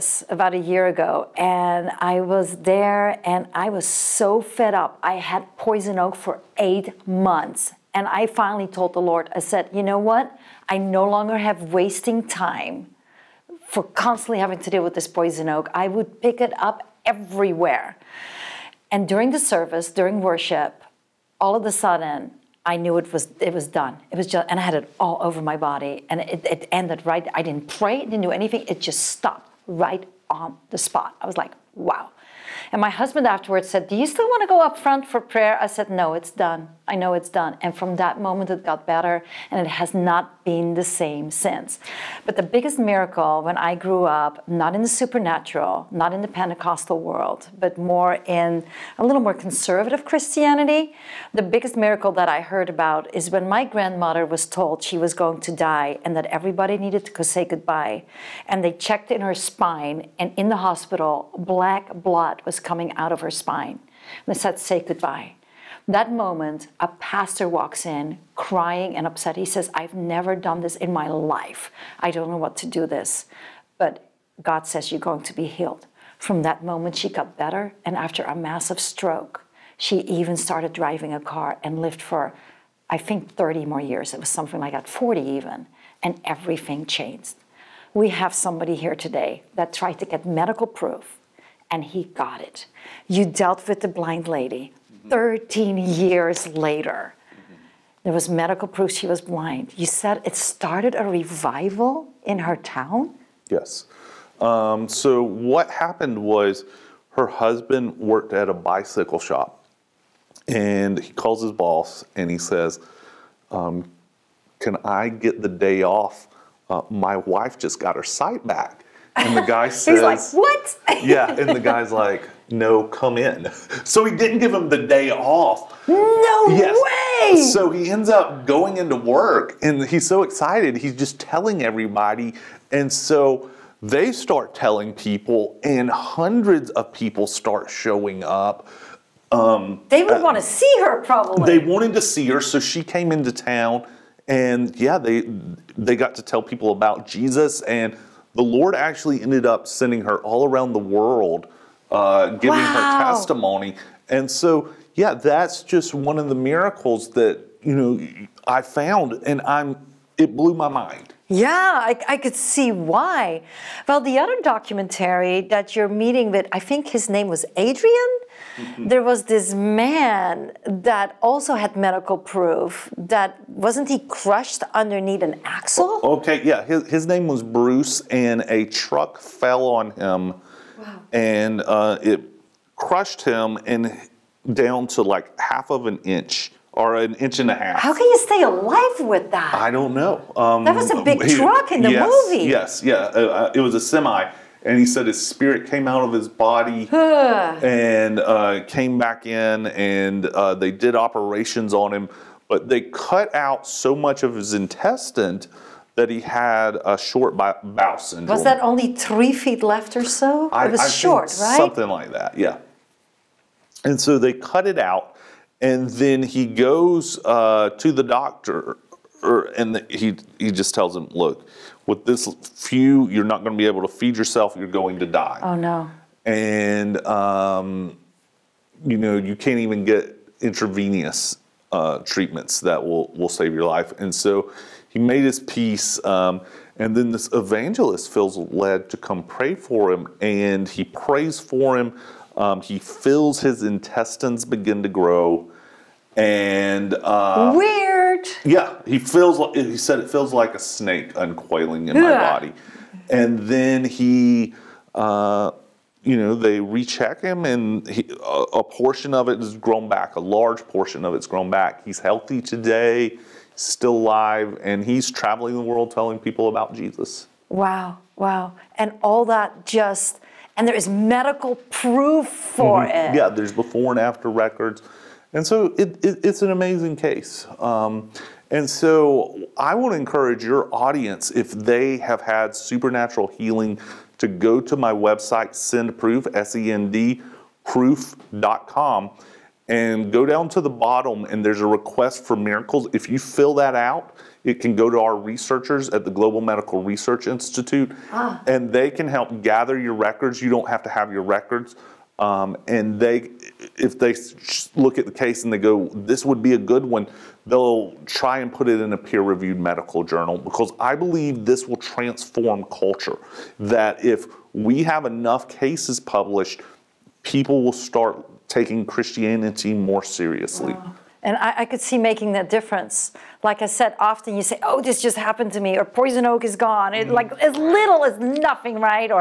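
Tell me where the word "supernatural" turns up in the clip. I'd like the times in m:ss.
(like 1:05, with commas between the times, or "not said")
0:44, 4:42.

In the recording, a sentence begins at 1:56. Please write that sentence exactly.
Uh, my wife just got her sight back.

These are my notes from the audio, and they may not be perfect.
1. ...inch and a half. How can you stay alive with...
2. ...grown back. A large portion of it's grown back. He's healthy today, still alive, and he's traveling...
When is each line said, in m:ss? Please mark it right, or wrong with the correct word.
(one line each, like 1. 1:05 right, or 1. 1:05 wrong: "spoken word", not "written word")
1. 3:07 right
2. 4:19 right.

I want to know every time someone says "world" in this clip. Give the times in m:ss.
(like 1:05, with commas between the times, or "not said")
0:46, 2:30, 4:25.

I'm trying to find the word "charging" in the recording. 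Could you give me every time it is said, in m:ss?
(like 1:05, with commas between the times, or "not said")
not said.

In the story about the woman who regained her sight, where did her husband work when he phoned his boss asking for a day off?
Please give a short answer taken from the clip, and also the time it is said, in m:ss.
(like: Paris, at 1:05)
bicycle shop, at 1:48.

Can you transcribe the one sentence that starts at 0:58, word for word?
And they checked in her spine, and in the hospital, black blood was coming out of her spine.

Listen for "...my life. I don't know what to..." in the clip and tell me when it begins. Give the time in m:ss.
1:10.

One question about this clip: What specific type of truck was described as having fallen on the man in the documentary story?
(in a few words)
semi.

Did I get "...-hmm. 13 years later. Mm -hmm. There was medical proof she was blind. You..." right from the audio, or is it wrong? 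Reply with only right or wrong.
right.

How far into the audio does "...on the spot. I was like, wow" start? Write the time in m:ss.
0:30.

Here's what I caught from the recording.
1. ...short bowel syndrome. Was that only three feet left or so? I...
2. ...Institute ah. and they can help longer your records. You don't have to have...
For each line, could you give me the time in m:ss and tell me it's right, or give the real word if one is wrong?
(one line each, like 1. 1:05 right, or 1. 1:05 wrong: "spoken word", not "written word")
1. 3:26 right
2. 4:57 wrong: "gather", not "longer".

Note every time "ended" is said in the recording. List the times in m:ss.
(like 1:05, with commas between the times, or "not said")
0:26, 2:29.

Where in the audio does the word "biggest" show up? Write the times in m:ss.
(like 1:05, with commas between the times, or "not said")
0:42, 0:51.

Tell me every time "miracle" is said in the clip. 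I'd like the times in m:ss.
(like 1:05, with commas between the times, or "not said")
0:42, 0:51, 2:36, 4:52.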